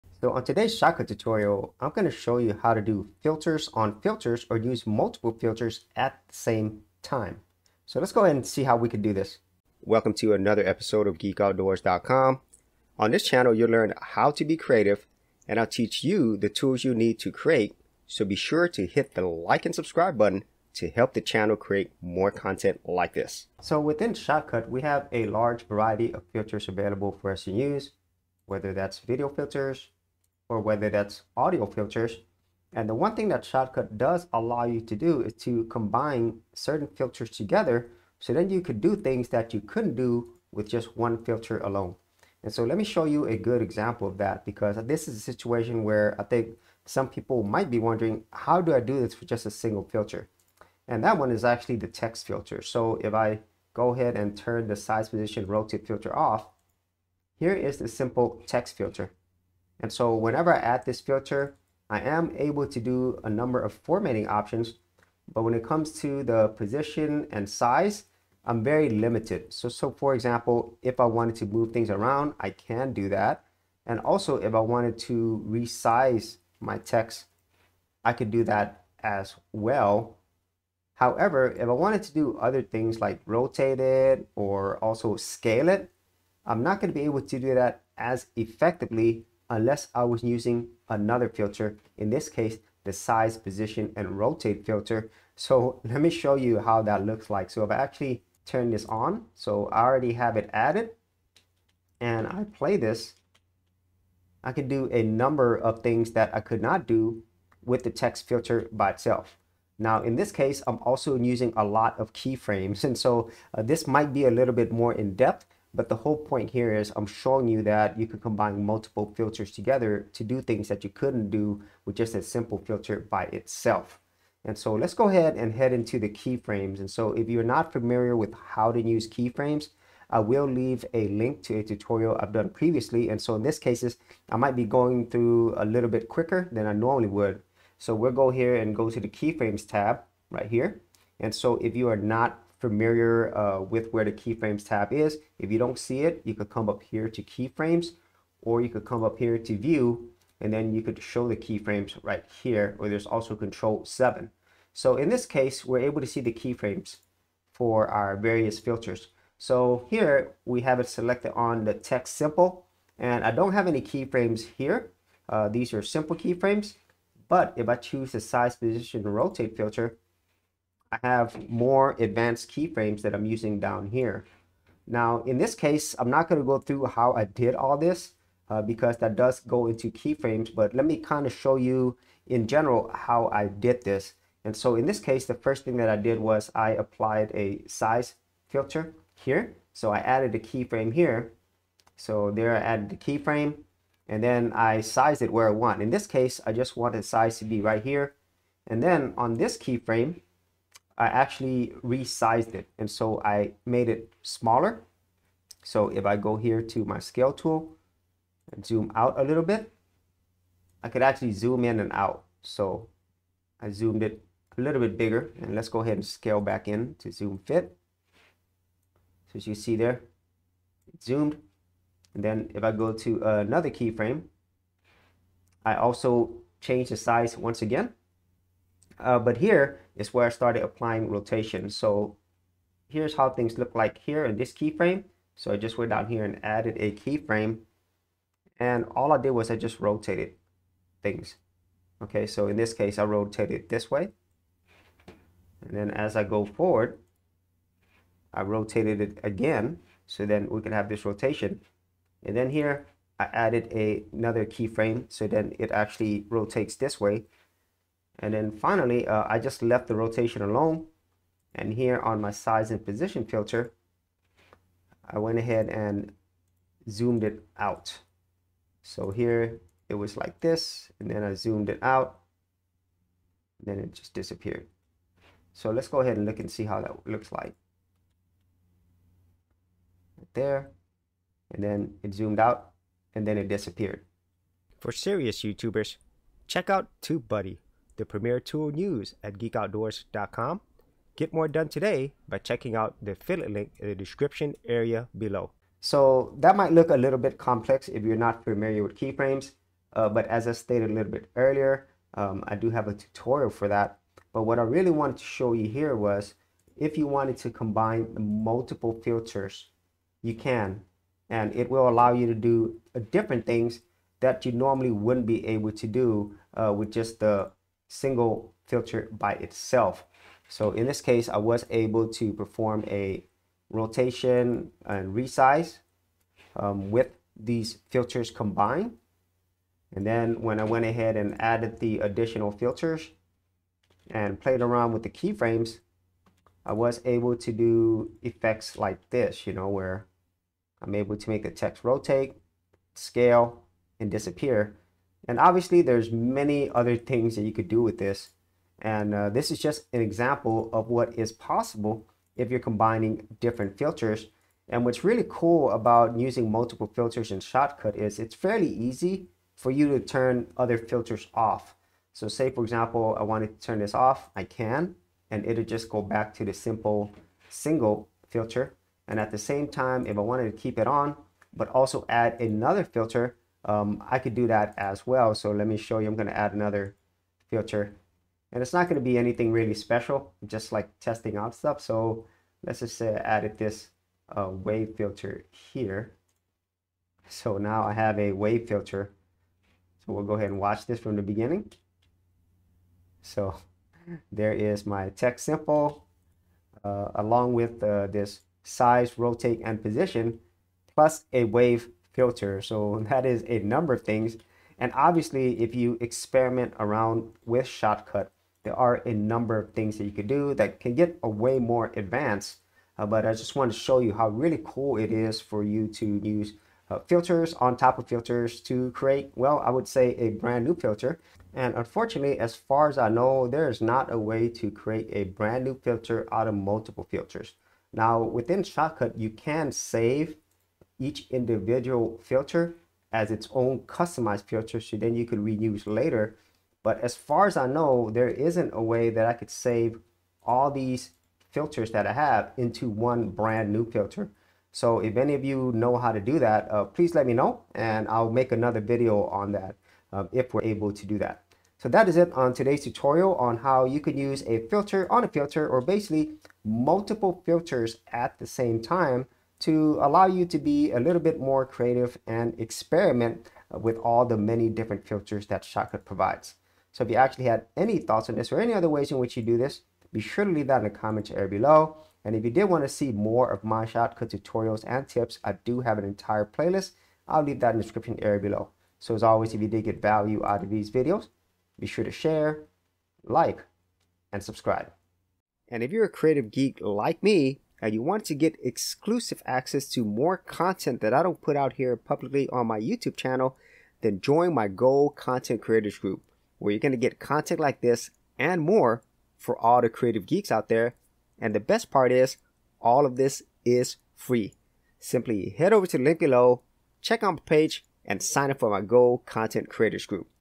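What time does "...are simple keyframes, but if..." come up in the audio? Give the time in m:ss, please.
2:45.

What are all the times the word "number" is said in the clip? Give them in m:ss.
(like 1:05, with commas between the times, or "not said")
1:03, 1:45, 6:43, 6:49.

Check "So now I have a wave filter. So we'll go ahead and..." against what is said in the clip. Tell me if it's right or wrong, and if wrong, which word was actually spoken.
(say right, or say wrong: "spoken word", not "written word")
right.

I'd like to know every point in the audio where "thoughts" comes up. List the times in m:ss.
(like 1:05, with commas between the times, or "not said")
7:47.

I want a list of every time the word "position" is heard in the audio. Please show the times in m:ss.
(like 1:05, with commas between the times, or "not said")
0:55, 1:06, 1:33, 2:48, 4:22, 6:39.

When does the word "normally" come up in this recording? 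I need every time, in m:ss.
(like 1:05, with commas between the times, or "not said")
2:16, 5:14.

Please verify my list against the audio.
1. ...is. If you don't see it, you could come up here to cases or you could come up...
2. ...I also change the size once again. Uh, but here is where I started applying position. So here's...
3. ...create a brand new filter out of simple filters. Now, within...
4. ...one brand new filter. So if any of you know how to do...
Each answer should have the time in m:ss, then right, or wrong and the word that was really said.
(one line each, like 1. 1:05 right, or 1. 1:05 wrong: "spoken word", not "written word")
1. 2:24 wrong: "keyframes", not "cases"
2. 3:45 wrong: "rotation", not "position"
3. 7:04 wrong: "multiple", not "simple"
4. 7:22 right.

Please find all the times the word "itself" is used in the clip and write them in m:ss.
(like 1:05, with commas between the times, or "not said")
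1:48, 2:03, 5:19.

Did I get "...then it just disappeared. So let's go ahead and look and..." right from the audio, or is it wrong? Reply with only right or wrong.
right.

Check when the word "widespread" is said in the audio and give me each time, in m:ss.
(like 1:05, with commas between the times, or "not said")
not said.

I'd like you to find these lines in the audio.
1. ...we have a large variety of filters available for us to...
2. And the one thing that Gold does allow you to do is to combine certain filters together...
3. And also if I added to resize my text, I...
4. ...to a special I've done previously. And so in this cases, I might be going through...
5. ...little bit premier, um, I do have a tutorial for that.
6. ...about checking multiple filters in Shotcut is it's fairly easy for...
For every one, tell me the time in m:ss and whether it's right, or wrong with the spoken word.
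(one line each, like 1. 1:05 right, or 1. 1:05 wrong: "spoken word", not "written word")
1. 0:24 right
2. 0:32 wrong: "Shotcut", not "Gold"
3. 1:13 wrong: "wanted", not "added"
4. 2:11 wrong: "tutorial", not "special"
5. 5:00 wrong: "earlier", not "premier"
6. 5:55 wrong: "using", not "checking".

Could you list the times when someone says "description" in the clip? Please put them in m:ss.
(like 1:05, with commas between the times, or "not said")
4:53, 7:57.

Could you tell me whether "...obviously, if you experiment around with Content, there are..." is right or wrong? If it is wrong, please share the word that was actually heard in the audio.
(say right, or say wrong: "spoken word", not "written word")
wrong: "Shotcut", not "Content".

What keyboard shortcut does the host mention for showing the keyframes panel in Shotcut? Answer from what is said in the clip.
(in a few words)
Control 7.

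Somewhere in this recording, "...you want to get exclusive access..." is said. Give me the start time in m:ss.
8:07.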